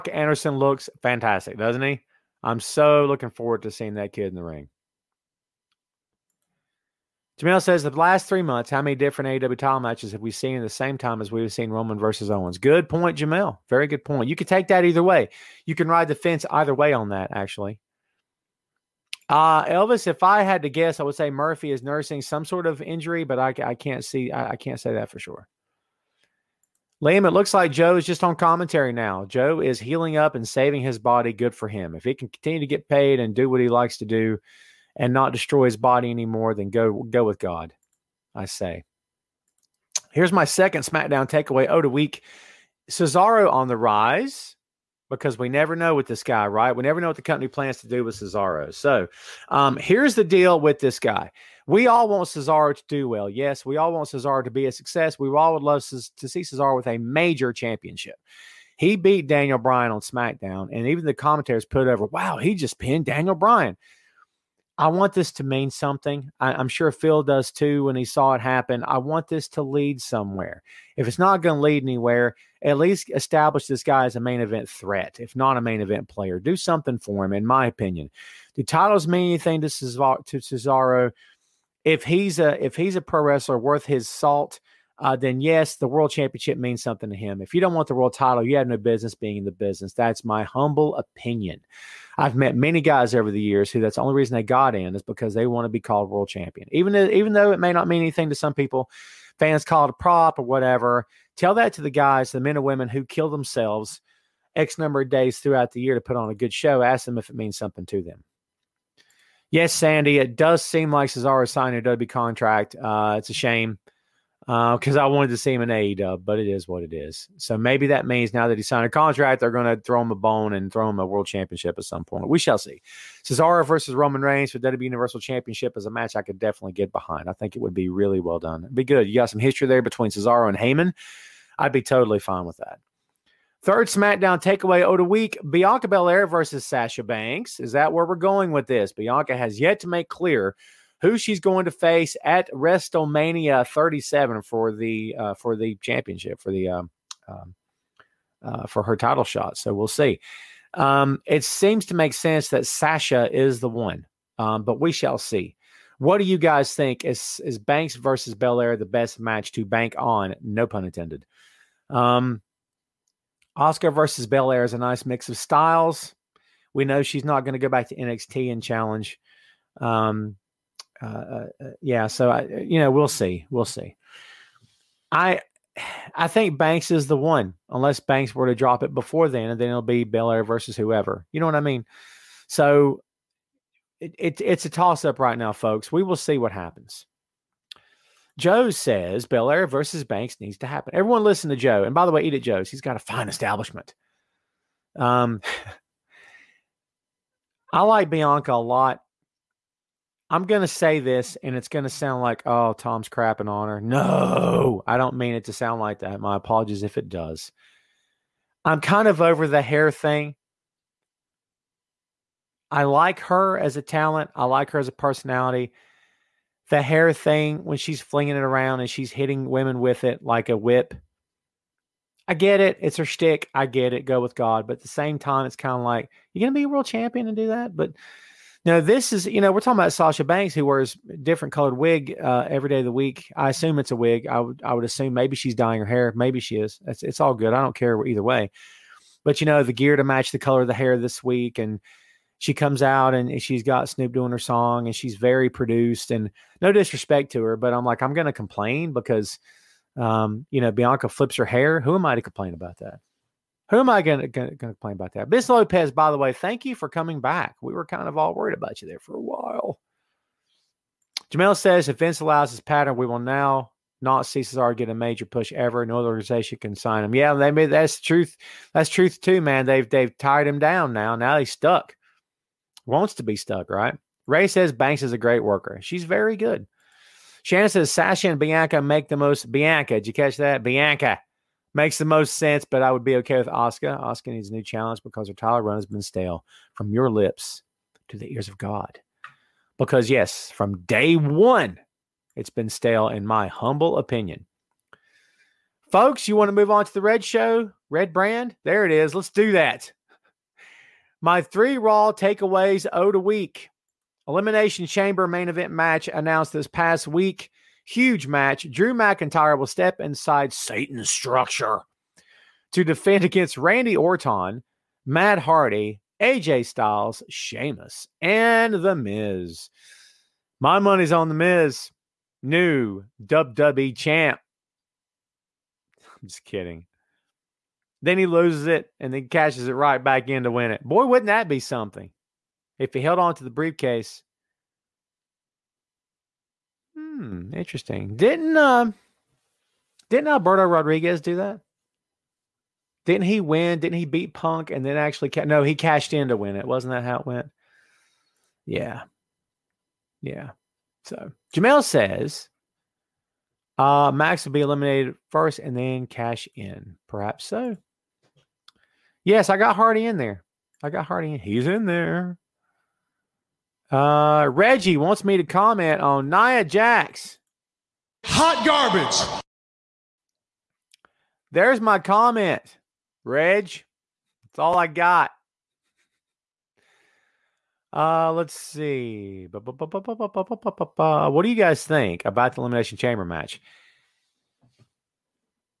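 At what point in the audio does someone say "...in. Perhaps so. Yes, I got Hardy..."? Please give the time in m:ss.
5:56.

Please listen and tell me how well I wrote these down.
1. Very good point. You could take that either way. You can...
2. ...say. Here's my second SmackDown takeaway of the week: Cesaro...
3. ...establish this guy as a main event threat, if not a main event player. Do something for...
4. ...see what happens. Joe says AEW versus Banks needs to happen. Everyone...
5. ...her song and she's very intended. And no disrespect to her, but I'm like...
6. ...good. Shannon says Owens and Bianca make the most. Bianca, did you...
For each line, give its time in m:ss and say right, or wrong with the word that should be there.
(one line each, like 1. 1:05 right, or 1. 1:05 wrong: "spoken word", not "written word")
1. 0:13 right
2. 0:38 right
3. 1:13 right
4. 3:06 wrong: "Belair", not "AEW"
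5. 4:04 wrong: "produced", not "intended"
6. 4:36 wrong: "Sasha", not "Owens".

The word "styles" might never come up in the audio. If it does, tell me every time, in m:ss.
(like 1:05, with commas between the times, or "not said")
2:45, 5:16.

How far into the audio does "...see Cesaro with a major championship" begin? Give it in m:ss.
0:56.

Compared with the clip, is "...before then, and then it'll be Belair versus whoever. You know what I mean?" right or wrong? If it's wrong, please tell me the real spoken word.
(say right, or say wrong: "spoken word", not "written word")
right.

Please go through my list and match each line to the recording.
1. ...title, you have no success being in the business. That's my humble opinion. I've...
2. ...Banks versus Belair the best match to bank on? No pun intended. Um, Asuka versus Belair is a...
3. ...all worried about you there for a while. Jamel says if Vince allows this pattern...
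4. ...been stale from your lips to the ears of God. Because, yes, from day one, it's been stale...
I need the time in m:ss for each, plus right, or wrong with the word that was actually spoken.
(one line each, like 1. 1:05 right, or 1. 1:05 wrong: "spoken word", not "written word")
1. 1:28 wrong: "business", not "success"
2. 2:37 right
3. 4:18 right
4. 4:45 right.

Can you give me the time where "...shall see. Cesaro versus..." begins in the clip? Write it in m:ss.
2:02.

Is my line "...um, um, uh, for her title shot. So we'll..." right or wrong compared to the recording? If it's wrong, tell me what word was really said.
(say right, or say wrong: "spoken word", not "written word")
right.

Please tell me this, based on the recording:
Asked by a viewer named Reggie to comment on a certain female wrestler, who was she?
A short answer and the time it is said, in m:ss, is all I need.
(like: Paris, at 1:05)
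Nia Jax, at 6:06.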